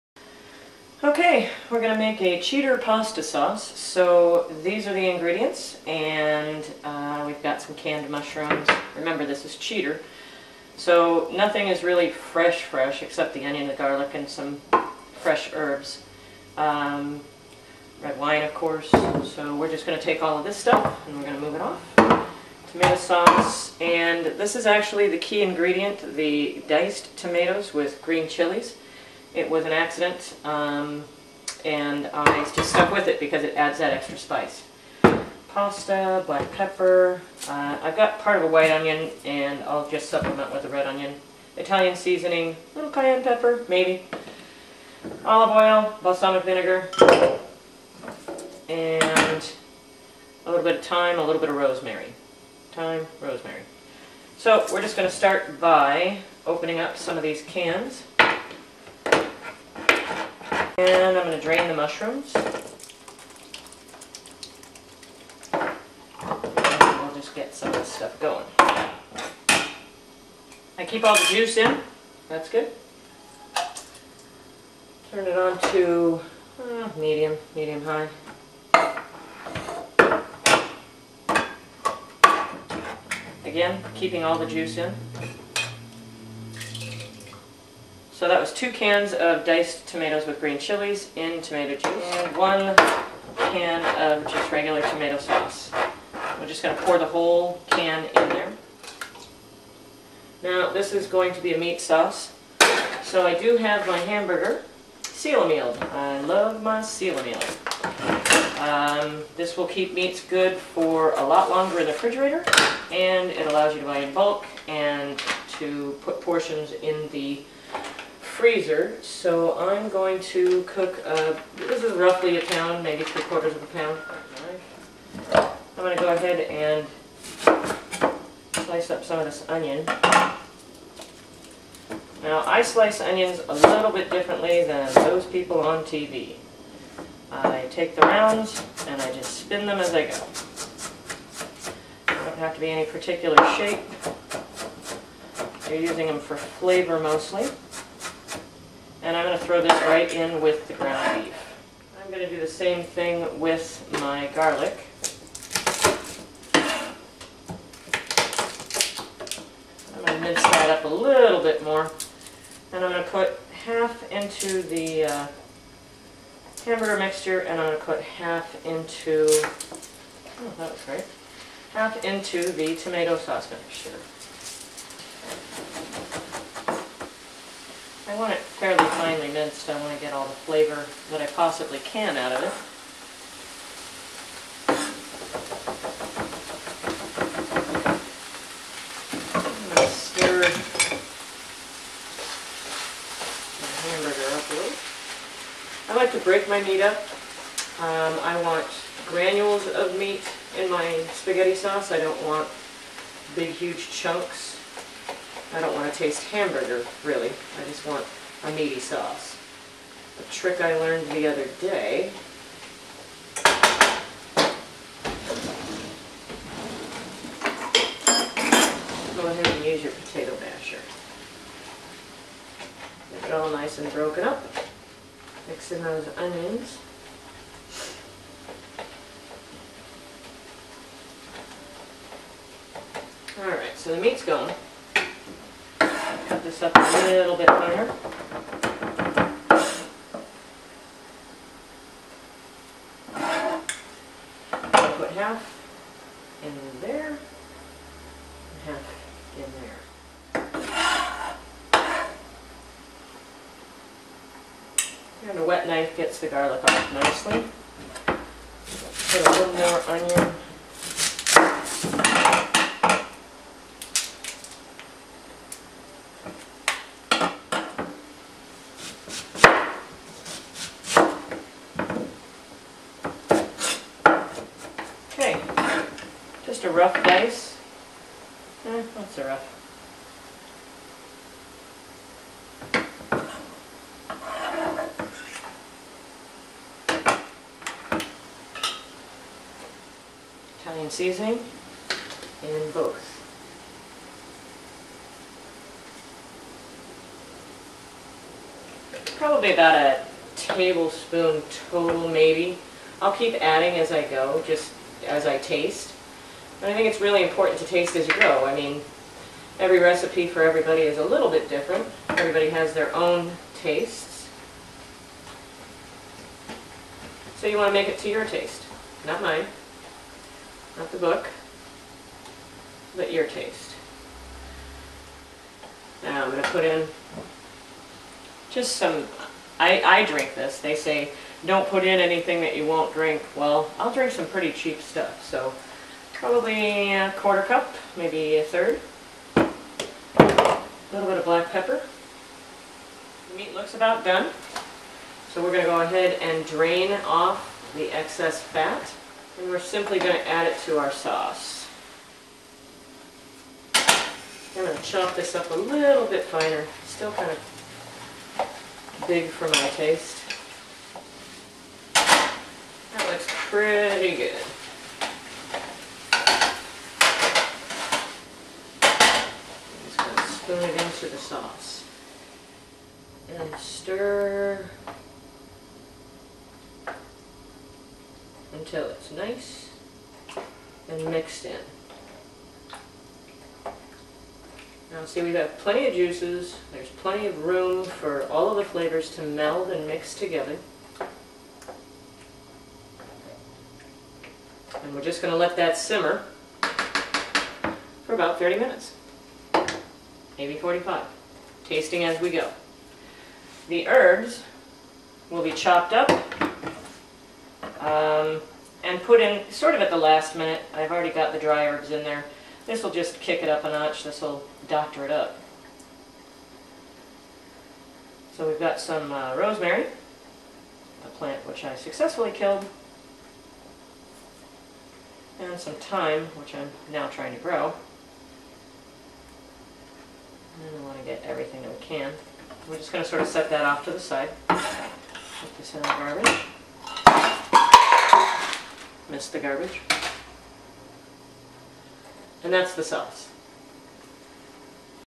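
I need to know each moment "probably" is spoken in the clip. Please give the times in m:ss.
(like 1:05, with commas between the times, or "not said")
4:59, 5:36.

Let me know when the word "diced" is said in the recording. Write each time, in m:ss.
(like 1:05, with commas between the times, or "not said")
0:26, 1:29.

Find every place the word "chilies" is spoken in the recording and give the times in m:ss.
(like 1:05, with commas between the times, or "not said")
0:28, 1:30.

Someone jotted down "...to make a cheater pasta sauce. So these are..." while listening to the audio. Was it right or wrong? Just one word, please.
right.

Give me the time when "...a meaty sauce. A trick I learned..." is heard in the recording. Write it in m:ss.
3:28.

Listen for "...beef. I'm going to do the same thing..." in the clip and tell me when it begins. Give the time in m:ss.
2:31.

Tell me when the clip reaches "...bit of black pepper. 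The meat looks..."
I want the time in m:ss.
5:41.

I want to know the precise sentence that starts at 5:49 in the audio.
And we're simply going to add it to our sauce.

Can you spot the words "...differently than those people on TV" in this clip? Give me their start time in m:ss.
2:14.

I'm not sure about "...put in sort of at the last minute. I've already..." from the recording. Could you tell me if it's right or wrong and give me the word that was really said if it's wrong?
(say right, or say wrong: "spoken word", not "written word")
right.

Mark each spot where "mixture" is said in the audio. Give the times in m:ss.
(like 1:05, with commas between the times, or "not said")
2:46, 2:53.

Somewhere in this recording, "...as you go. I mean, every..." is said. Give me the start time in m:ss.
5:07.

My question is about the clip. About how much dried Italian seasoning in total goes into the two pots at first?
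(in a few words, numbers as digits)
1 tablespoon.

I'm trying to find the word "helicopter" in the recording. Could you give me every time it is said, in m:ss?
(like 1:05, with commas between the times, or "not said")
not said.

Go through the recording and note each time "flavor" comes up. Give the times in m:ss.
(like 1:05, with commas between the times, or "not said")
2:26, 3:00, 6:28.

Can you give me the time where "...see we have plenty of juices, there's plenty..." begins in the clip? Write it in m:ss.
6:25.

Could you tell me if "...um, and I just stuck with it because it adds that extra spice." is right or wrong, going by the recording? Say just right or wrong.
right.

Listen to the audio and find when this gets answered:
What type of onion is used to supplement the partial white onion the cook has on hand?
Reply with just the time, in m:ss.
0:40.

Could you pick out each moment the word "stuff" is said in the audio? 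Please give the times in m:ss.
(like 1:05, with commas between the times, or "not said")
0:20, 1:07, 5:34.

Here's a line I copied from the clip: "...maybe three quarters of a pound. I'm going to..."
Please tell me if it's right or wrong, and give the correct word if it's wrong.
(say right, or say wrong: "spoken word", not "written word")
right.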